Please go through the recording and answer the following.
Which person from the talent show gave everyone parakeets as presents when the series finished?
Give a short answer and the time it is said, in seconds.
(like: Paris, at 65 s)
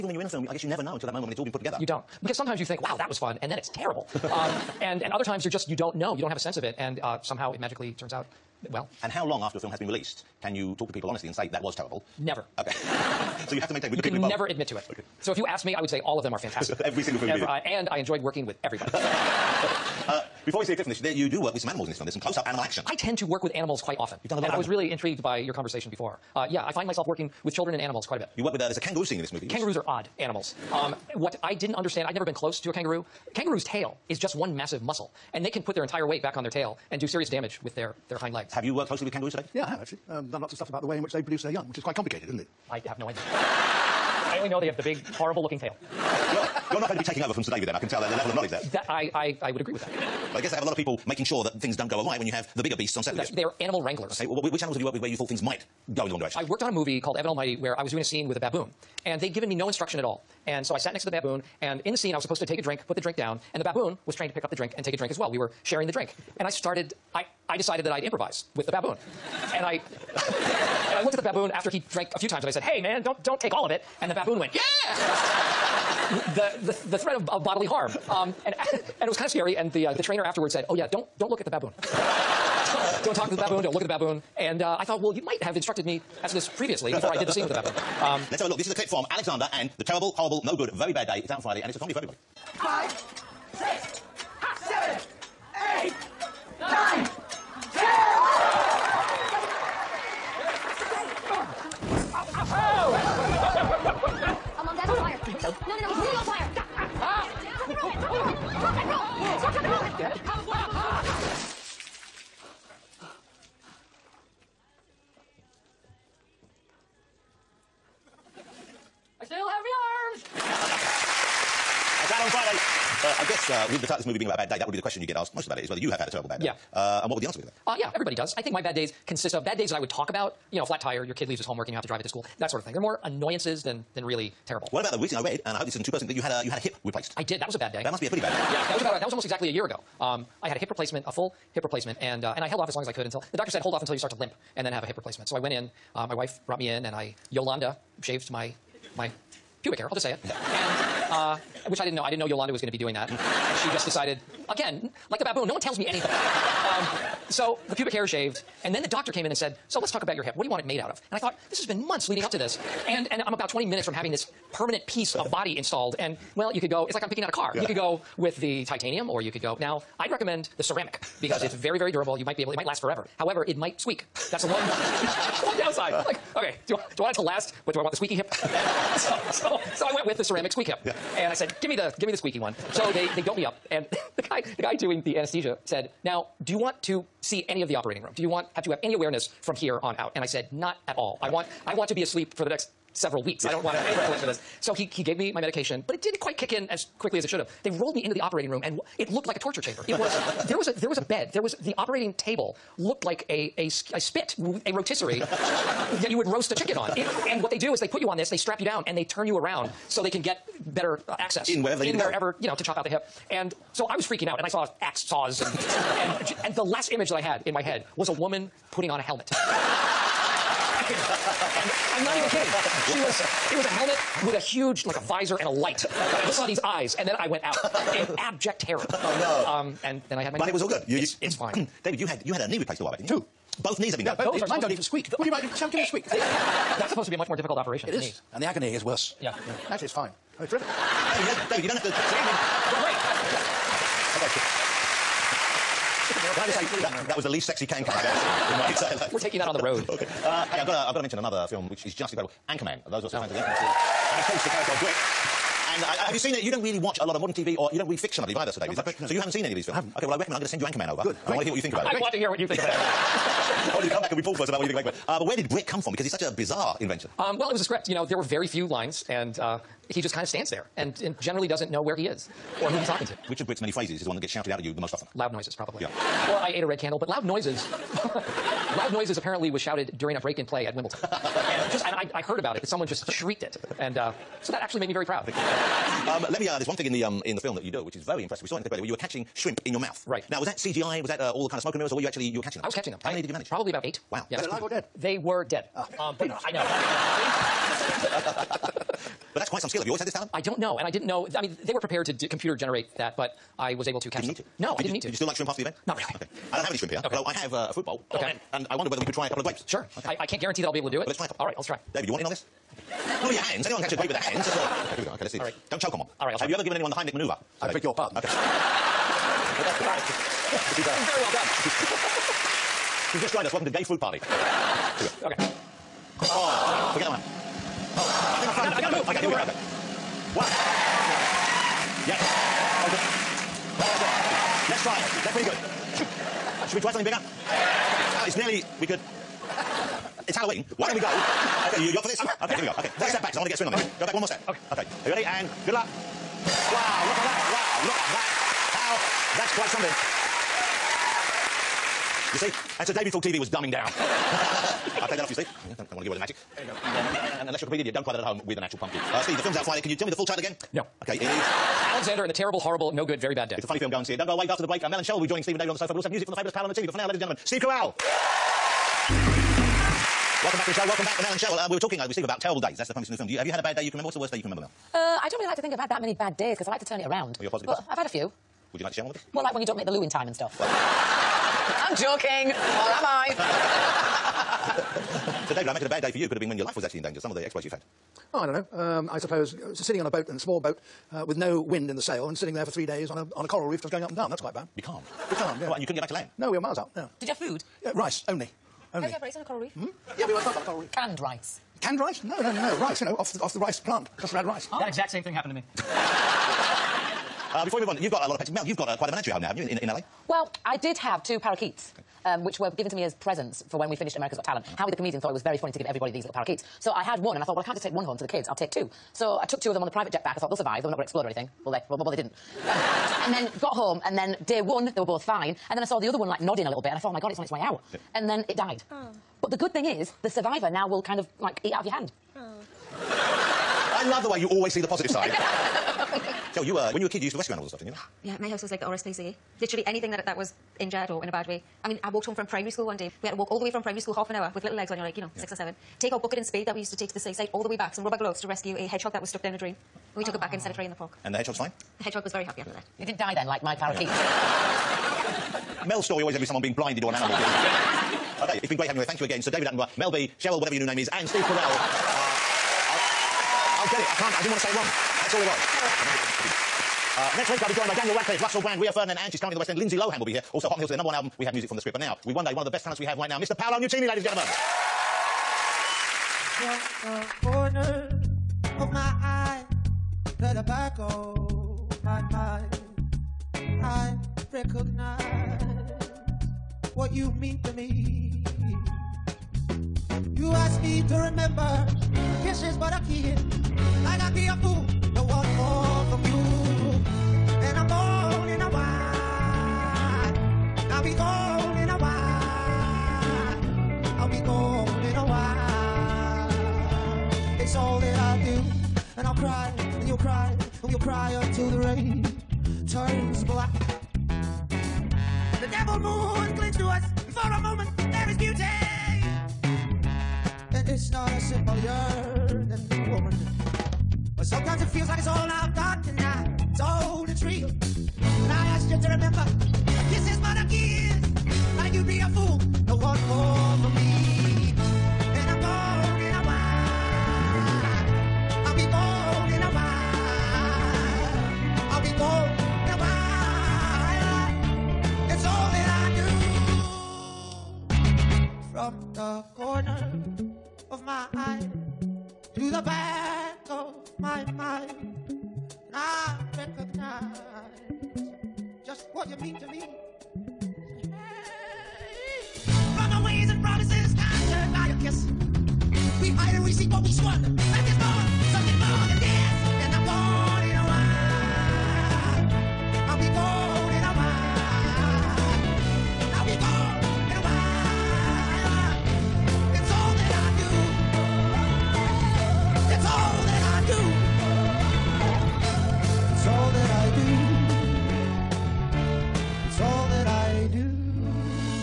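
Howie, at 414 s.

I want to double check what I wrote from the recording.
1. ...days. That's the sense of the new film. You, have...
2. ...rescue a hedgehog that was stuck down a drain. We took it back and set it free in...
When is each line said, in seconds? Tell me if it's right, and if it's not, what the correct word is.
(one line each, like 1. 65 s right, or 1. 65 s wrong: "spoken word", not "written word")
1. 372 s wrong: "premise", not "sense"
2. 448 s right.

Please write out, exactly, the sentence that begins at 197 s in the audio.
They rolled me into the operating room, and it looked like a torture chamber.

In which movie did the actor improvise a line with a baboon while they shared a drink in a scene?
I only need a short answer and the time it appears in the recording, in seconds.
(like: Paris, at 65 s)
Evan Almighty, at 57 s.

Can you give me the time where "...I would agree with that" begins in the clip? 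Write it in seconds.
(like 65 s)
49 s.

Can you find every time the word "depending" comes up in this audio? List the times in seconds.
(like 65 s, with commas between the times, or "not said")
not said.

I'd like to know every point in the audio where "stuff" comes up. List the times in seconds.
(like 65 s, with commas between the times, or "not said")
40 s, 380 s, 437 s.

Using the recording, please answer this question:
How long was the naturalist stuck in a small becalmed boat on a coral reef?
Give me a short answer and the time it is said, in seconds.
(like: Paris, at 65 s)
3 days, at 392 s.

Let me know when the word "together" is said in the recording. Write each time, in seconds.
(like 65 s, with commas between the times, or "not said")
1 s.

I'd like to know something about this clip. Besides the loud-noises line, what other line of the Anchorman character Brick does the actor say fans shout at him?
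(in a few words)
I ate a red candle.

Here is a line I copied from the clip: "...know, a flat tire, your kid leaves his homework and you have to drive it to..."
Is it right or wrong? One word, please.
right.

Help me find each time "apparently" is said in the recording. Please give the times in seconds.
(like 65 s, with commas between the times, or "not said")
279 s.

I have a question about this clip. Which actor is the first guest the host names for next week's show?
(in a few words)
Daniel Radcliffe.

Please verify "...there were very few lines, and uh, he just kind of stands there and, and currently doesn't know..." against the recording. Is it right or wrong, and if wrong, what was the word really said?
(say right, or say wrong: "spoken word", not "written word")
wrong: "generally", not "currently".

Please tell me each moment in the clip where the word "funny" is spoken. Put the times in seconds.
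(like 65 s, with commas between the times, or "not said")
363 s, 415 s.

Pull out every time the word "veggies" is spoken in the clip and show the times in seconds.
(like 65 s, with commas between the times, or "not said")
not said.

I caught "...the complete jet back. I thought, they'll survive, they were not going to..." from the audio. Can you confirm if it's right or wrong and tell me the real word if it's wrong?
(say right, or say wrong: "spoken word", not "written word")
wrong: "private", not "complete".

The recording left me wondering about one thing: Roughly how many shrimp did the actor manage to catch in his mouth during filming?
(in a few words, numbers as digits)
8.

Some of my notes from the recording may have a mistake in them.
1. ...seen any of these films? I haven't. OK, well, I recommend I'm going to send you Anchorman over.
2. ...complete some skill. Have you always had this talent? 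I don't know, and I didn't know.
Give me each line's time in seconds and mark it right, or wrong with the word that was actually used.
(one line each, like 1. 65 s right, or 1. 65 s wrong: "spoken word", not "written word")
1. 259 s right
2. 299 s wrong: "quite", not "complete".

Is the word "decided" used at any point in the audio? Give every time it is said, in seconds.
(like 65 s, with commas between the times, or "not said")
67 s, 153 s.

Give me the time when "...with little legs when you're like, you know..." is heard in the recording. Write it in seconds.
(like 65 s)
444 s.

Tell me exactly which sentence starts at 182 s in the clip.
So they, they doped me up.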